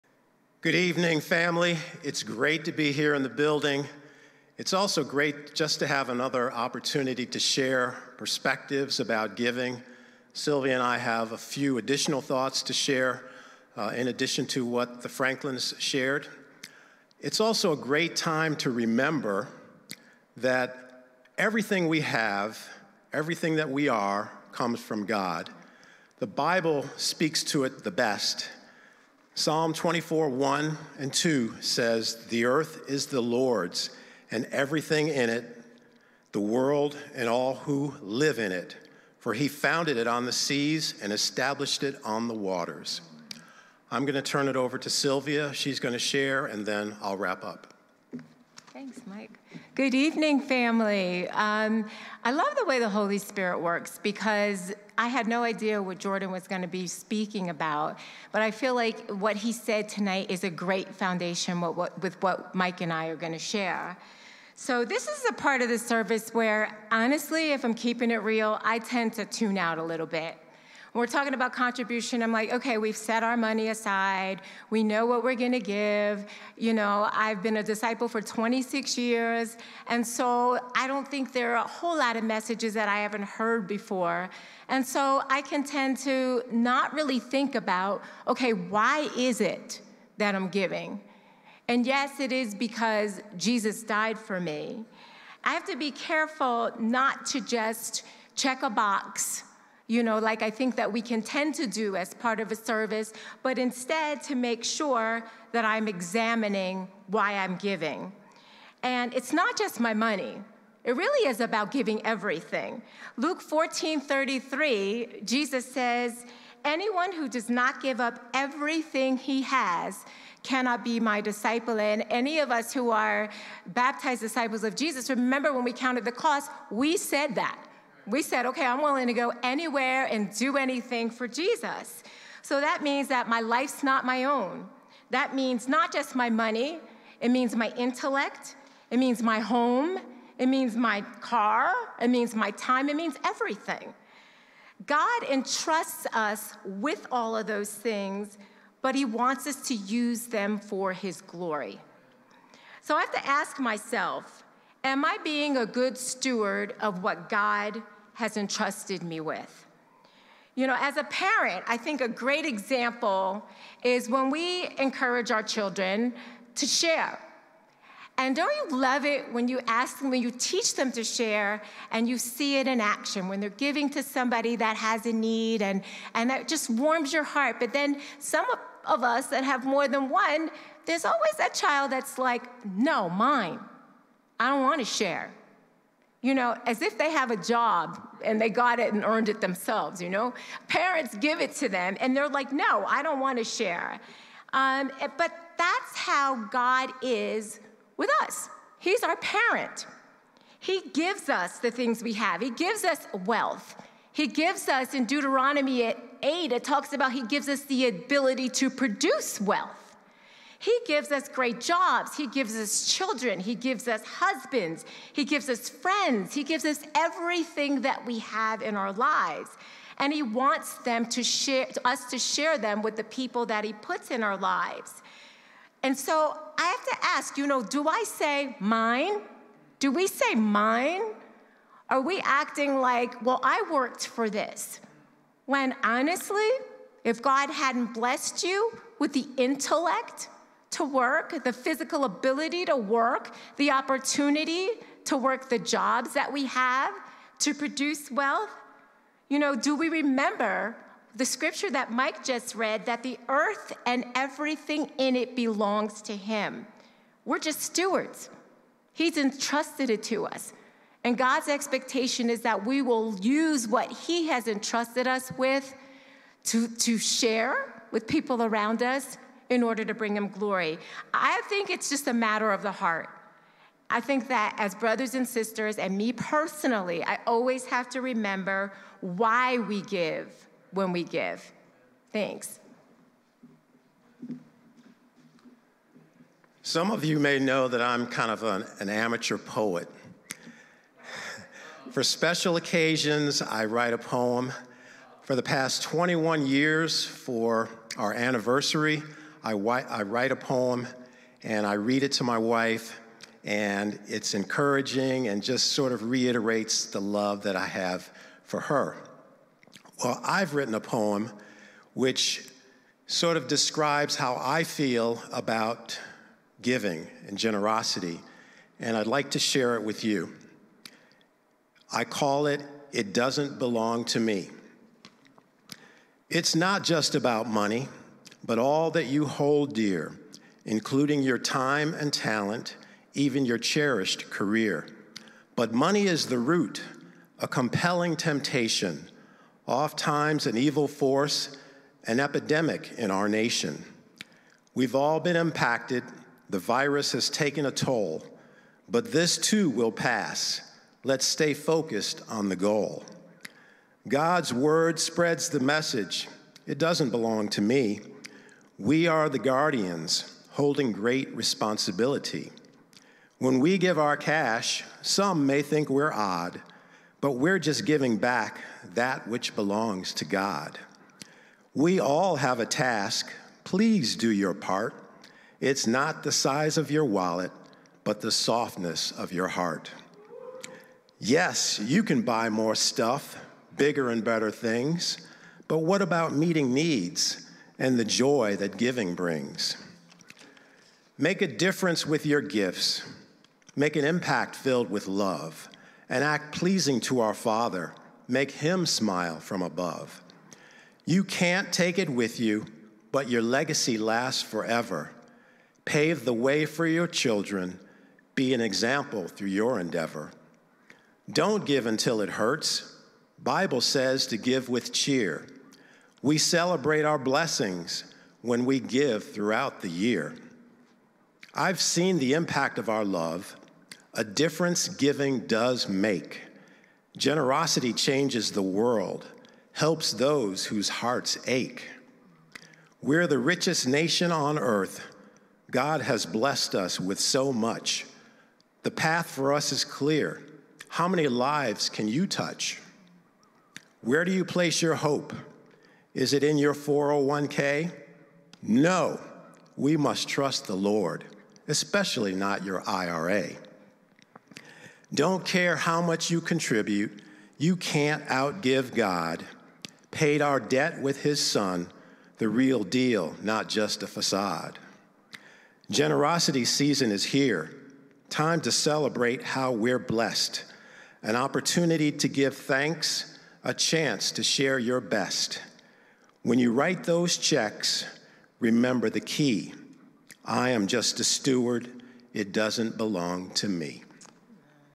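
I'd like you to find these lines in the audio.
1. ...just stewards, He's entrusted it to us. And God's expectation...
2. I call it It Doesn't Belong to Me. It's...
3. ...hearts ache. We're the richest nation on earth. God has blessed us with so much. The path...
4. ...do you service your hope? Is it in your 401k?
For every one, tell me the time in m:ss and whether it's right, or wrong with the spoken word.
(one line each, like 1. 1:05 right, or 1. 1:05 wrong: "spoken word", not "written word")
1. 4:17 right
2. 5:21 right
3. 7:10 right
4. 7:24 wrong: "place", not "service".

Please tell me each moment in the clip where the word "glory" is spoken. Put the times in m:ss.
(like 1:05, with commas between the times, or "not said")
2:31, 4:30.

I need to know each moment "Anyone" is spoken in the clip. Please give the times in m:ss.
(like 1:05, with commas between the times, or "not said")
1:56.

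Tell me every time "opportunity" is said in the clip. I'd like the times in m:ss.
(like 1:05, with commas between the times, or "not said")
0:06, 4:03, 7:51.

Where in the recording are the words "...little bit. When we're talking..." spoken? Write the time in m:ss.
1:09.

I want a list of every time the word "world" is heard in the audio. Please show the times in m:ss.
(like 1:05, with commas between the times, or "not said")
0:36, 7:08.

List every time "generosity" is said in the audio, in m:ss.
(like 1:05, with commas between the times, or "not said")
5:17, 7:07, 7:45.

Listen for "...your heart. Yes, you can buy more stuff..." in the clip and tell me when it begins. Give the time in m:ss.
6:19.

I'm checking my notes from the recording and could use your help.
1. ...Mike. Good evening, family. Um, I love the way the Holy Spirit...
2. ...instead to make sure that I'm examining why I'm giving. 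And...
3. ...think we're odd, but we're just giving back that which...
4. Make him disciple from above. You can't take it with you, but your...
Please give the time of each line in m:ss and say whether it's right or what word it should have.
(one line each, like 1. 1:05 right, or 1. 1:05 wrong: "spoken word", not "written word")
1. 0:49 right
2. 1:43 right
3. 6:05 right
4. 6:38 wrong: "smile", not "disciple".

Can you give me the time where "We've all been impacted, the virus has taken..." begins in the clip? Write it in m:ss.
5:44.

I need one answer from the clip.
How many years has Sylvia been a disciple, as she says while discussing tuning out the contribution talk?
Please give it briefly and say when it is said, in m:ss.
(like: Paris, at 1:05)
26, at 1:18.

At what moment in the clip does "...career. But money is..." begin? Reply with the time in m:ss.
5:34.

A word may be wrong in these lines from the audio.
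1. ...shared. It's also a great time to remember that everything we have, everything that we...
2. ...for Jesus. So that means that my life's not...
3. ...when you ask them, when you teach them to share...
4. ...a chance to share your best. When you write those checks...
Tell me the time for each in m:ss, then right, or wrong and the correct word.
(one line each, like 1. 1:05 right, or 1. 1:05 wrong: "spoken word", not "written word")
1. 0:15 right
2. 2:11 right
3. 2:49 right
4. 7:53 right.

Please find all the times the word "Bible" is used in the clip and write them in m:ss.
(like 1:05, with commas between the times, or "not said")
0:26, 6:53.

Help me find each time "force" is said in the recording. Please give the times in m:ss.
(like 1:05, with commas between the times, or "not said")
5:40.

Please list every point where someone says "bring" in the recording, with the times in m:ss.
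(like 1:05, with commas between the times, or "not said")
4:29, 6:29.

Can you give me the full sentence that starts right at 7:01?
I've seen the impact of our love.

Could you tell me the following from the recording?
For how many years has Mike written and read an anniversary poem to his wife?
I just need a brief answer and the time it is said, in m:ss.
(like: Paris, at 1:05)
21, at 4:55.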